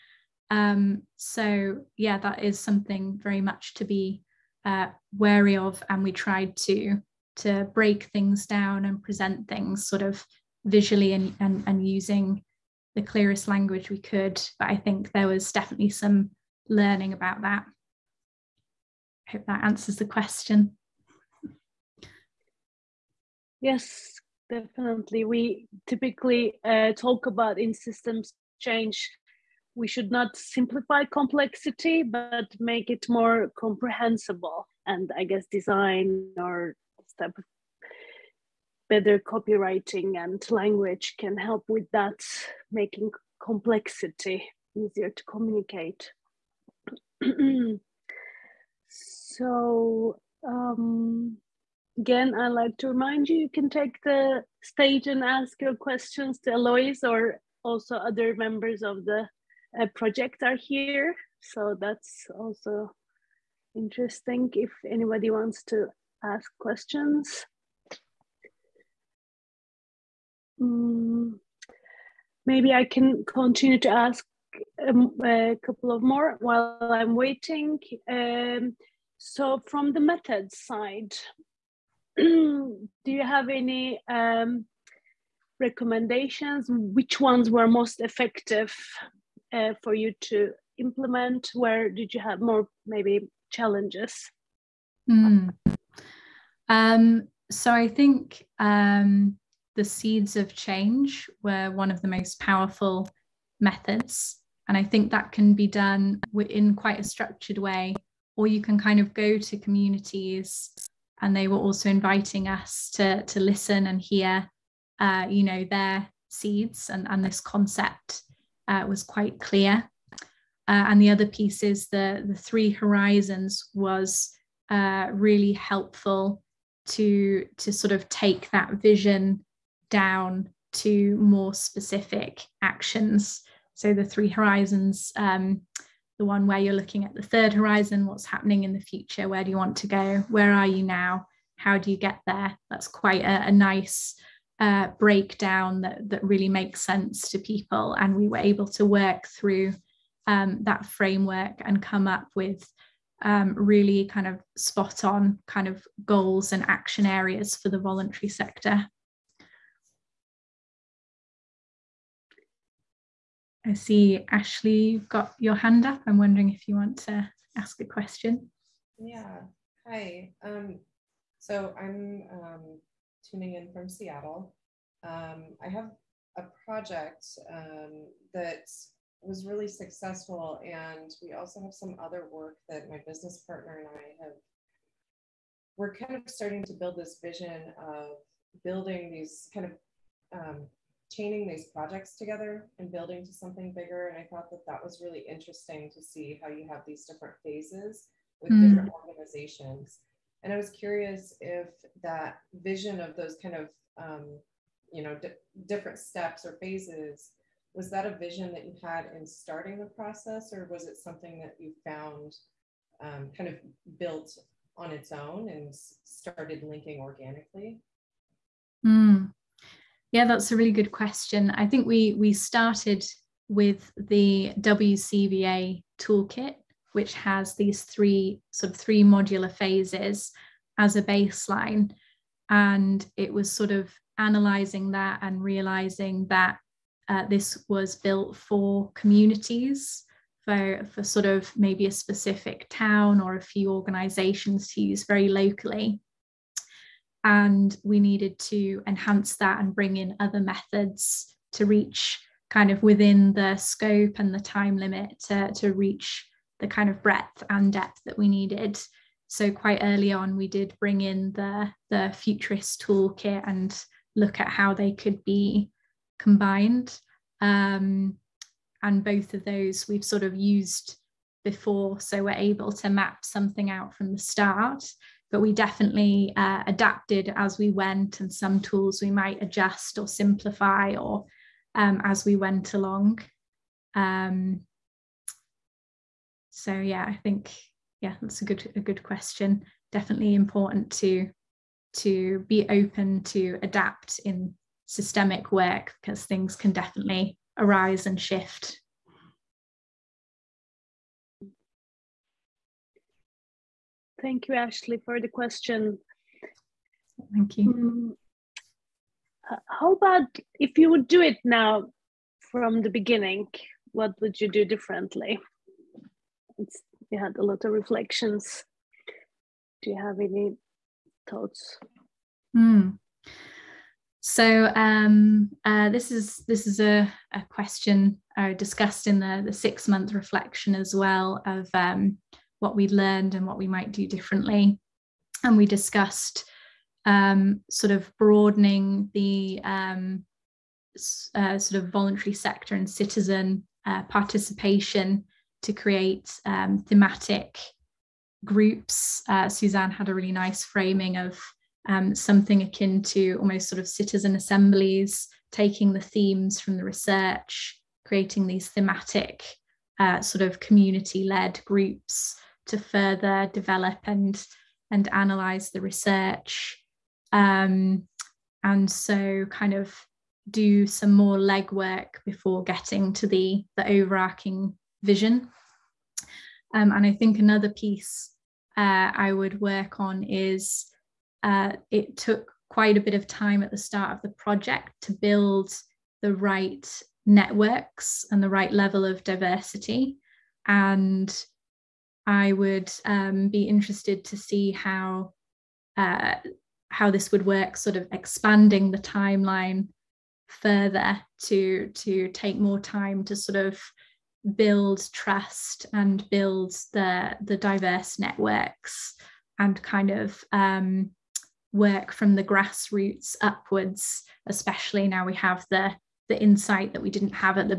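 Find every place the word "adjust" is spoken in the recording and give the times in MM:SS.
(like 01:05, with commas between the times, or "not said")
04:39.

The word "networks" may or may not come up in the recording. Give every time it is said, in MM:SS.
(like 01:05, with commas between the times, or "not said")
06:27, 06:48.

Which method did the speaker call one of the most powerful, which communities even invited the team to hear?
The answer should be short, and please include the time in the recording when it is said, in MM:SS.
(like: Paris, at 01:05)
seeds of change, at 01:39.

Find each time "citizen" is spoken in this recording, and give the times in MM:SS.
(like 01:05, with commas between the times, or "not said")
05:42, 05:53.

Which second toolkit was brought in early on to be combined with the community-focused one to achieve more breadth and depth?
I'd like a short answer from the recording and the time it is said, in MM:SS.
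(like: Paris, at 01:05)
Futurice, at 04:22.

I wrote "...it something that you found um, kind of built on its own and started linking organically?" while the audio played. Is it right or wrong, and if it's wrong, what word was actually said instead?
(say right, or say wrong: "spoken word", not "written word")
right.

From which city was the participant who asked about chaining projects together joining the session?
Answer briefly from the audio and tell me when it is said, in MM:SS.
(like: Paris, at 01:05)
Seattle, at 02:53.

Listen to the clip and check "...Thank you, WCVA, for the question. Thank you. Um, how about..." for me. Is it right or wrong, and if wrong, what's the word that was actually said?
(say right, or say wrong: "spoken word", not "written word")
wrong: "Ashley", not "WCVA".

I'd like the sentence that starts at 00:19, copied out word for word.
I hope that answers the question.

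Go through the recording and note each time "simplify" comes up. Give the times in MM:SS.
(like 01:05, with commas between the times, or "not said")
00:30, 04:40.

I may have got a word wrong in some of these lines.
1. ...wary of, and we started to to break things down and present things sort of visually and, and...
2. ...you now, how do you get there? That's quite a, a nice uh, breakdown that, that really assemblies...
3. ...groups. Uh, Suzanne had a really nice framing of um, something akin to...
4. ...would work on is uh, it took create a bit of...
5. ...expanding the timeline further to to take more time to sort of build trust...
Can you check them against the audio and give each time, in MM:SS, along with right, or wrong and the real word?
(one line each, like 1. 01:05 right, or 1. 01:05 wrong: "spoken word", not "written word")
1. 00:05 wrong: "tried", not "started"
2. 02:20 wrong: "makes", not "assemblies"
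3. 05:48 right
4. 06:19 wrong: "quite", not "create"
5. 06:38 right.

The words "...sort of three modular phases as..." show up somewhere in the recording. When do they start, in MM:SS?
03:48.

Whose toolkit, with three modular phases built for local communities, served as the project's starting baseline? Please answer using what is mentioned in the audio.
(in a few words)
WCVA.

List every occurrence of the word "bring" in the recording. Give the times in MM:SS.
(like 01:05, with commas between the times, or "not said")
04:09, 04:20.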